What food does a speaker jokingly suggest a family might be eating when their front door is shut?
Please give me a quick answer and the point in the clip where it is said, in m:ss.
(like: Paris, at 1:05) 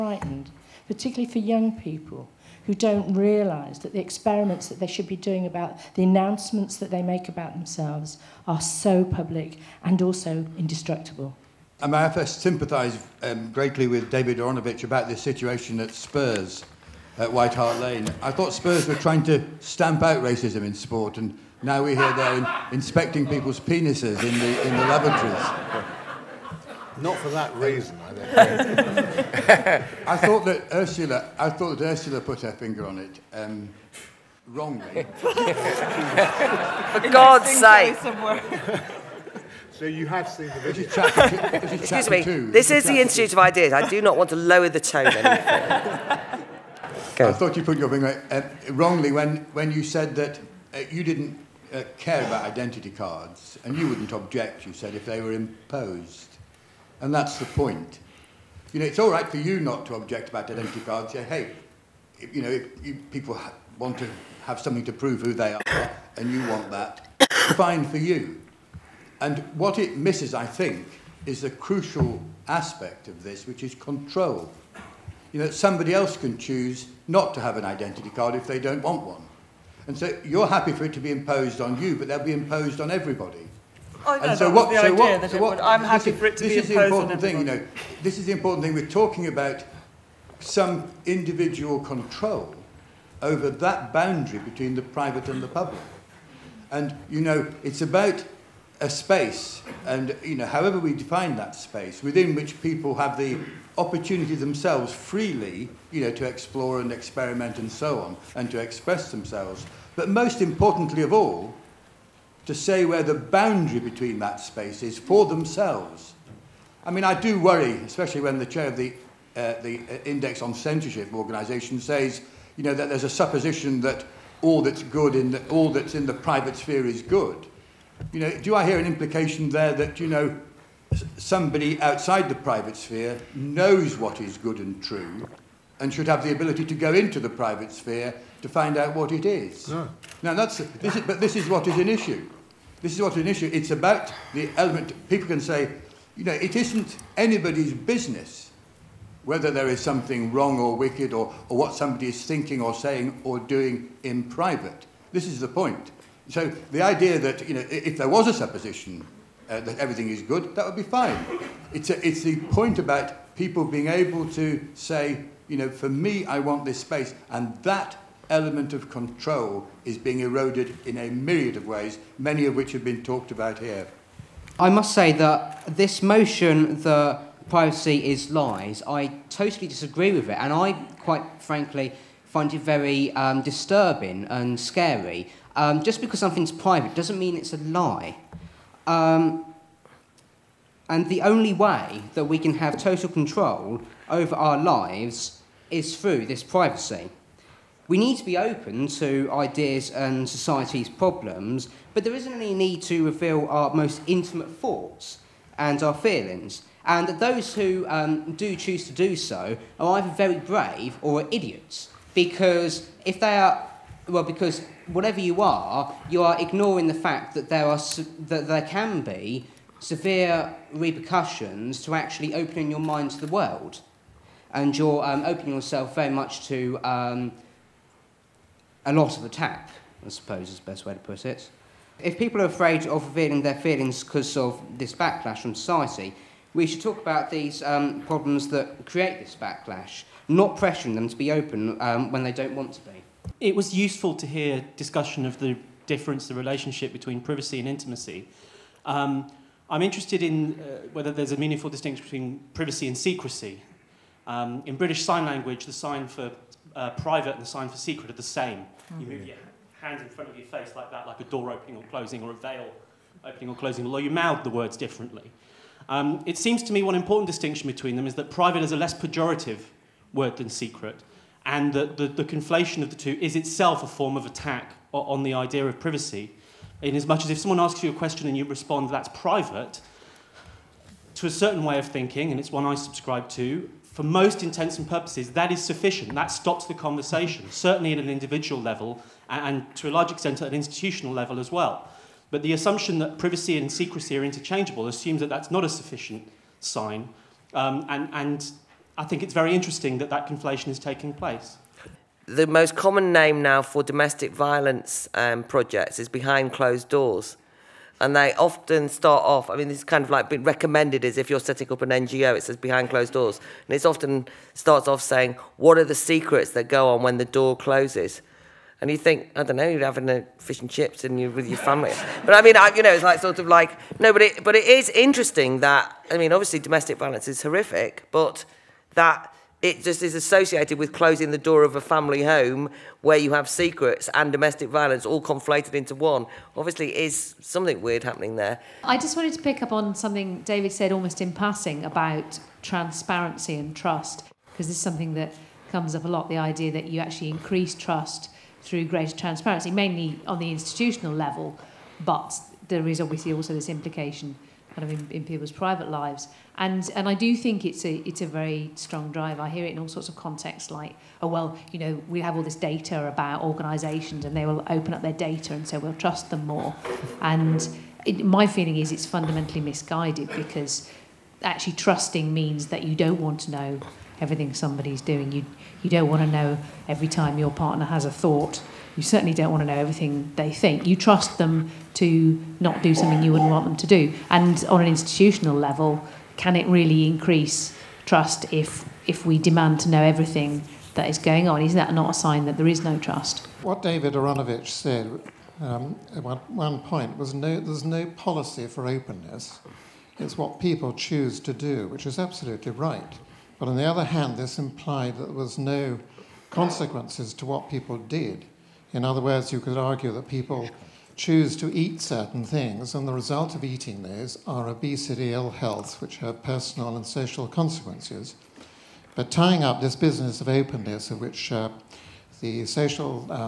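Fish and chips, at 5:20.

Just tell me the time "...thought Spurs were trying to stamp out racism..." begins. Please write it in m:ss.
0:18.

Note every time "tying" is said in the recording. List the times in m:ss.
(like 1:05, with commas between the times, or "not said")
6:59.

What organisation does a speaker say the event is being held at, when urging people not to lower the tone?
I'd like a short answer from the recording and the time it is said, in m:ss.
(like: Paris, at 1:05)
Institute of Ideas, at 0:43.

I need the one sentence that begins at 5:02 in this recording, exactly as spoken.
The most common name now for domestic violence um, projects is behind closed doors.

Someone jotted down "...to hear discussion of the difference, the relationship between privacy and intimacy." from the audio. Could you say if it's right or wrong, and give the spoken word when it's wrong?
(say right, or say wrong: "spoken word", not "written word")
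right.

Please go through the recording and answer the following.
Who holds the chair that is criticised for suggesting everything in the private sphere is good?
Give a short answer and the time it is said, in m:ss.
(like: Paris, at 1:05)
Index on Censorship, at 2:00.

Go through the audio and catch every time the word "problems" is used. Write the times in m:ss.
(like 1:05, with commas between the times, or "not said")
3:20, 3:58.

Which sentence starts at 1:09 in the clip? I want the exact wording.
And what it misses, I think, is the crucial aspect of this, which is control.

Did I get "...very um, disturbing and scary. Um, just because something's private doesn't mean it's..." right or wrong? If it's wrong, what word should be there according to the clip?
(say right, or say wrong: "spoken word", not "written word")
right.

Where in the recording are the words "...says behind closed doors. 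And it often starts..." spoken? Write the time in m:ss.
5:12.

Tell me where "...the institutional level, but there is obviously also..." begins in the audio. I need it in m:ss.
5:50.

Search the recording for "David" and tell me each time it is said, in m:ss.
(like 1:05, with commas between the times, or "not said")
0:14, 5:40, 6:33.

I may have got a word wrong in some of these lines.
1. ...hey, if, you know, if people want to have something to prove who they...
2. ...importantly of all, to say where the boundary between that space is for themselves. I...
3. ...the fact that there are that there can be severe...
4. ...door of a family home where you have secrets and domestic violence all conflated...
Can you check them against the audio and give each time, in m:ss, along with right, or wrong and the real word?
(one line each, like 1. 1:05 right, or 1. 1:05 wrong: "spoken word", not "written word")
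1. 1:01 right
2. 1:50 right
3. 3:36 right
4. 5:31 right.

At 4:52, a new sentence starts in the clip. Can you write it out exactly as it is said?
But the assumption that privacy and secrecy are interchangeable assumes that that's not a sufficient sign.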